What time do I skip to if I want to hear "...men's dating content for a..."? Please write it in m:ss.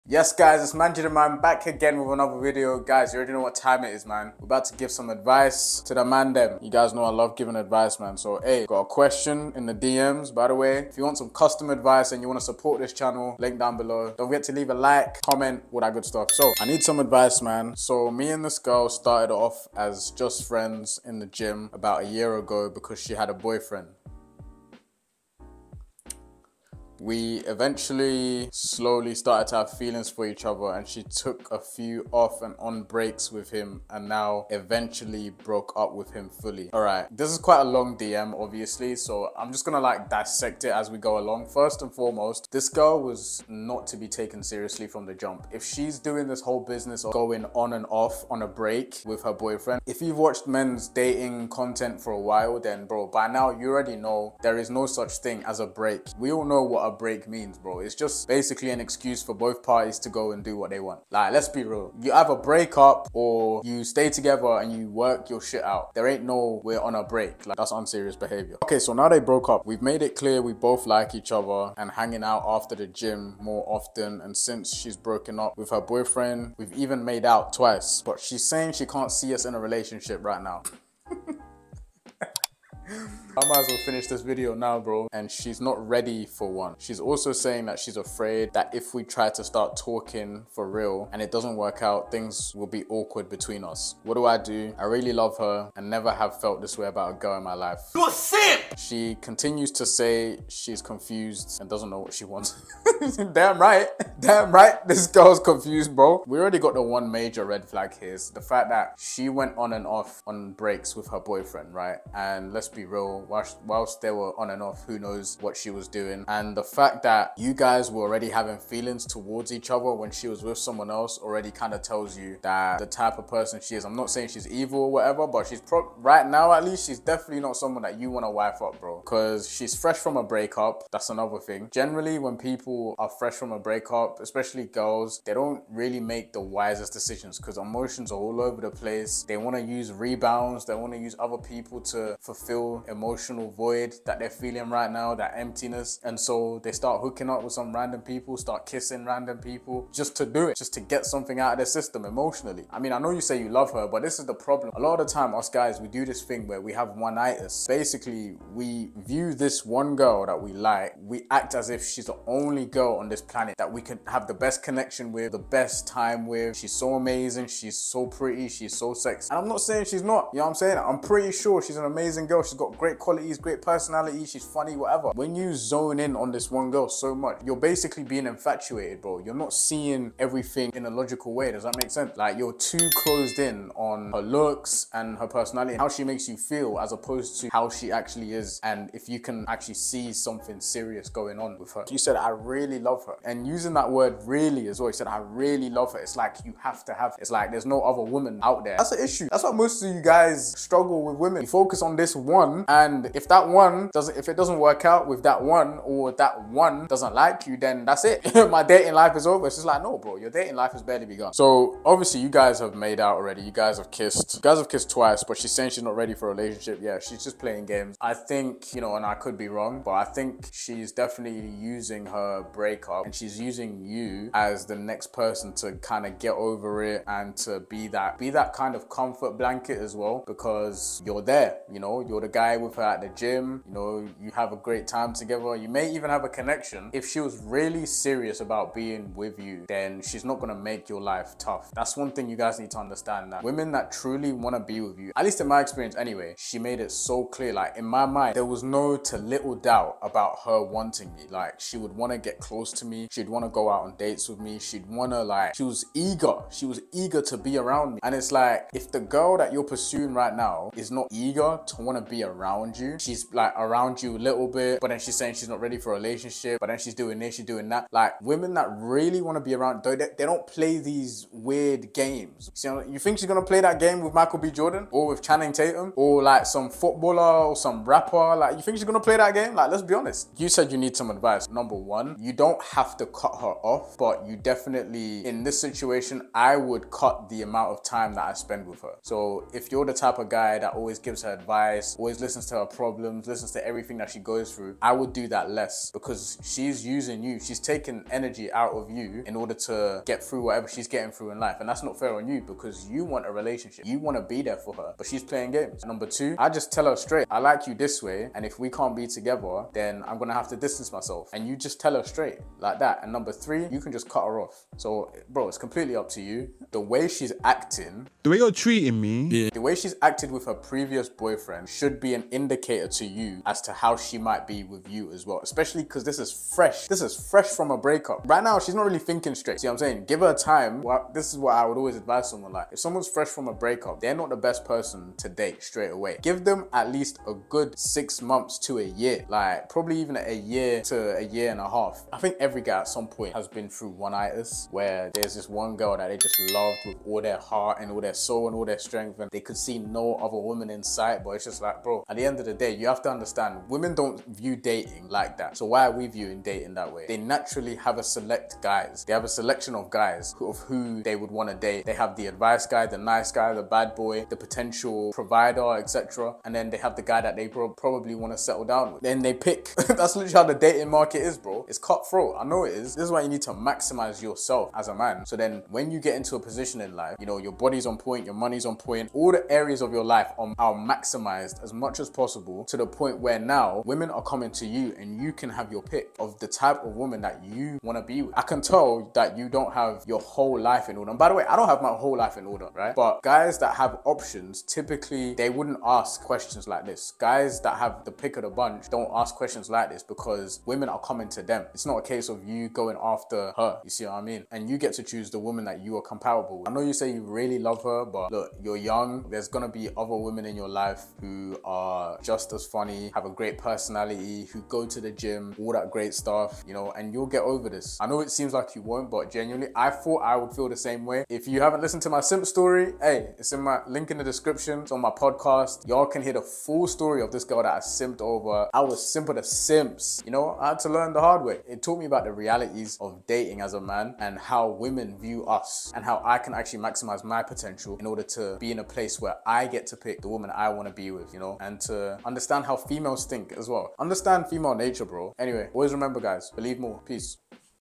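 0:50.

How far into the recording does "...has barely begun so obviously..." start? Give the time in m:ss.
3:30.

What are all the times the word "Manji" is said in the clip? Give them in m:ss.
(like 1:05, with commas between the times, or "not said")
0:00.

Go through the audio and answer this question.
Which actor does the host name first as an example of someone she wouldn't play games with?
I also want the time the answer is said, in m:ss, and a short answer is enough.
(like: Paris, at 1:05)
Michael B. Jordan, at 4:34.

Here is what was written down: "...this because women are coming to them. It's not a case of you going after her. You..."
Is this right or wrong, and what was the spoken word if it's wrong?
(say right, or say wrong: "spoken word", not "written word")
right.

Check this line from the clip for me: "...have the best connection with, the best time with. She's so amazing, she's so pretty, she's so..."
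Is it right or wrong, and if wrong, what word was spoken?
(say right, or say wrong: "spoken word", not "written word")
right.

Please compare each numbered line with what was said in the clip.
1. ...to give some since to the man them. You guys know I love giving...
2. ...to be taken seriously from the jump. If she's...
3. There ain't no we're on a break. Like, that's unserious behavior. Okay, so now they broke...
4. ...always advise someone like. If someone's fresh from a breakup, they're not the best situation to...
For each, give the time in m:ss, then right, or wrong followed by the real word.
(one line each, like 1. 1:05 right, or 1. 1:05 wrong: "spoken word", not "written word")
1. 0:04 wrong: "advice", not "since"
2. 0:43 right
3. 1:05 right
4. 5:31 wrong: "person", not "situation".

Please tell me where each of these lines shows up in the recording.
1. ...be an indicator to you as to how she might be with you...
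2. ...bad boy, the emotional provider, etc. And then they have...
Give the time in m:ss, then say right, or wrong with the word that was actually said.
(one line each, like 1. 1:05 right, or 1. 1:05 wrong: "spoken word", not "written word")
1. 5:22 right
2. 6:03 wrong: "potential", not "emotional".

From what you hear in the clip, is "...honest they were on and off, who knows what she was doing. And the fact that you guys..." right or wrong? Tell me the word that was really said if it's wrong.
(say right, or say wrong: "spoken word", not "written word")
wrong: "whilst", not "honest".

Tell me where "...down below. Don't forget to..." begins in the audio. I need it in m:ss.
0:13.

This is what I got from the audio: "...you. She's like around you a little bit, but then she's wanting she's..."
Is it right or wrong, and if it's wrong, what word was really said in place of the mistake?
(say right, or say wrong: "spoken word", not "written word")
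wrong: "saying", not "wanting".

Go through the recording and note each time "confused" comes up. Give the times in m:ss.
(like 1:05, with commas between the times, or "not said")
1:40, 1:45.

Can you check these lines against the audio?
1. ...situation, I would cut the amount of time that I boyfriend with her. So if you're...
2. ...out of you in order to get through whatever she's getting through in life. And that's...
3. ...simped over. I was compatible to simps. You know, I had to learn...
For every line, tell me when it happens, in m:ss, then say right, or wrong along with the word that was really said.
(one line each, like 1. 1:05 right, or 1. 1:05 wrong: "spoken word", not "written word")
1. 4:45 wrong: "spend", not "boyfriend"
2. 4:58 right
3. 7:07 wrong: "simple", not "compatible".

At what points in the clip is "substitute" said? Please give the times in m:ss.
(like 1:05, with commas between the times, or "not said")
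not said.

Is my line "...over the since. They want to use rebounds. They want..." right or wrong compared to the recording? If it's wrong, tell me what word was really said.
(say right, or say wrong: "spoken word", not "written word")
wrong: "place", not "since".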